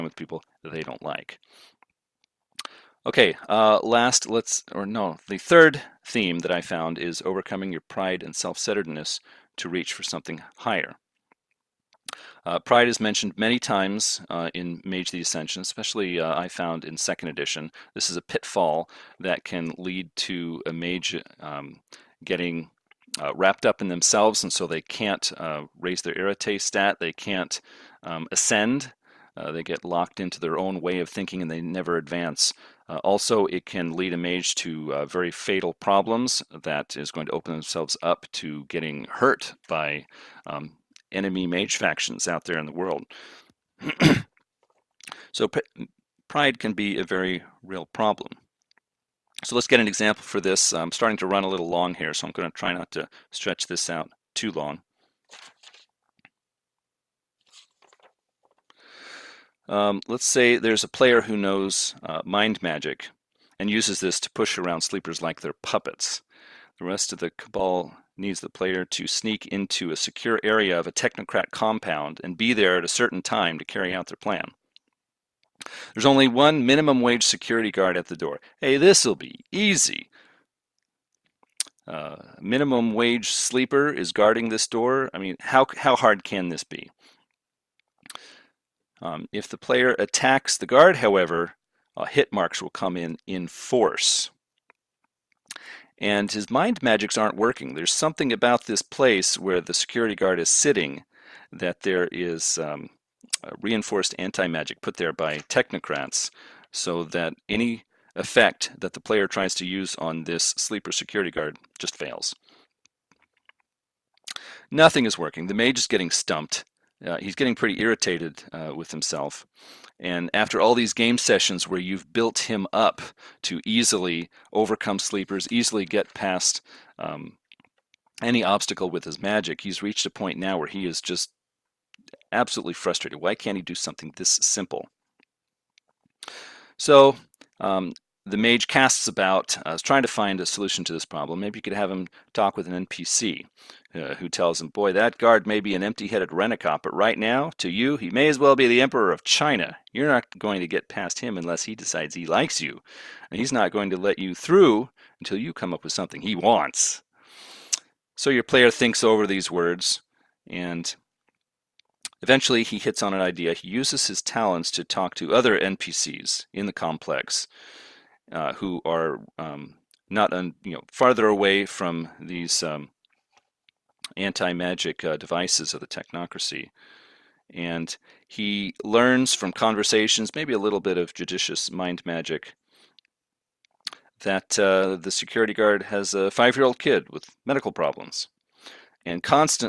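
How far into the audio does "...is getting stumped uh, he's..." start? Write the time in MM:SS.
01:55.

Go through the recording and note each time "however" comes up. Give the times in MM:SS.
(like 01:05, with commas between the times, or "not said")
01:30.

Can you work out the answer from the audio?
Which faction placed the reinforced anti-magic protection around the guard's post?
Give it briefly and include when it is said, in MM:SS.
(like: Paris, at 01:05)
Technocrats, at 01:45.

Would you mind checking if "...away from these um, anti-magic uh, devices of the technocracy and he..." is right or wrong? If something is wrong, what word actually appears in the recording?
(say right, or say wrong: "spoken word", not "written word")
right.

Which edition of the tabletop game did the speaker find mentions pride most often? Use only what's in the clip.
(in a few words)
Second edition.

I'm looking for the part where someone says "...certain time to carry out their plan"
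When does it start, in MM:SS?
01:12.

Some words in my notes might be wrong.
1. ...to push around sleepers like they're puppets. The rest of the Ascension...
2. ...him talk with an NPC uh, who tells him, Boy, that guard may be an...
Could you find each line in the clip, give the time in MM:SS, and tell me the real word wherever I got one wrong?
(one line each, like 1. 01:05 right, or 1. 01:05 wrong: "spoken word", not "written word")
1. 01:04 wrong: "Cabal", not "Ascension"
2. 02:21 right.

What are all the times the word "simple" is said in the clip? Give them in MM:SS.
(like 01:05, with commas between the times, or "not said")
02:14.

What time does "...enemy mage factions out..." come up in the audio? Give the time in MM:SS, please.
00:41.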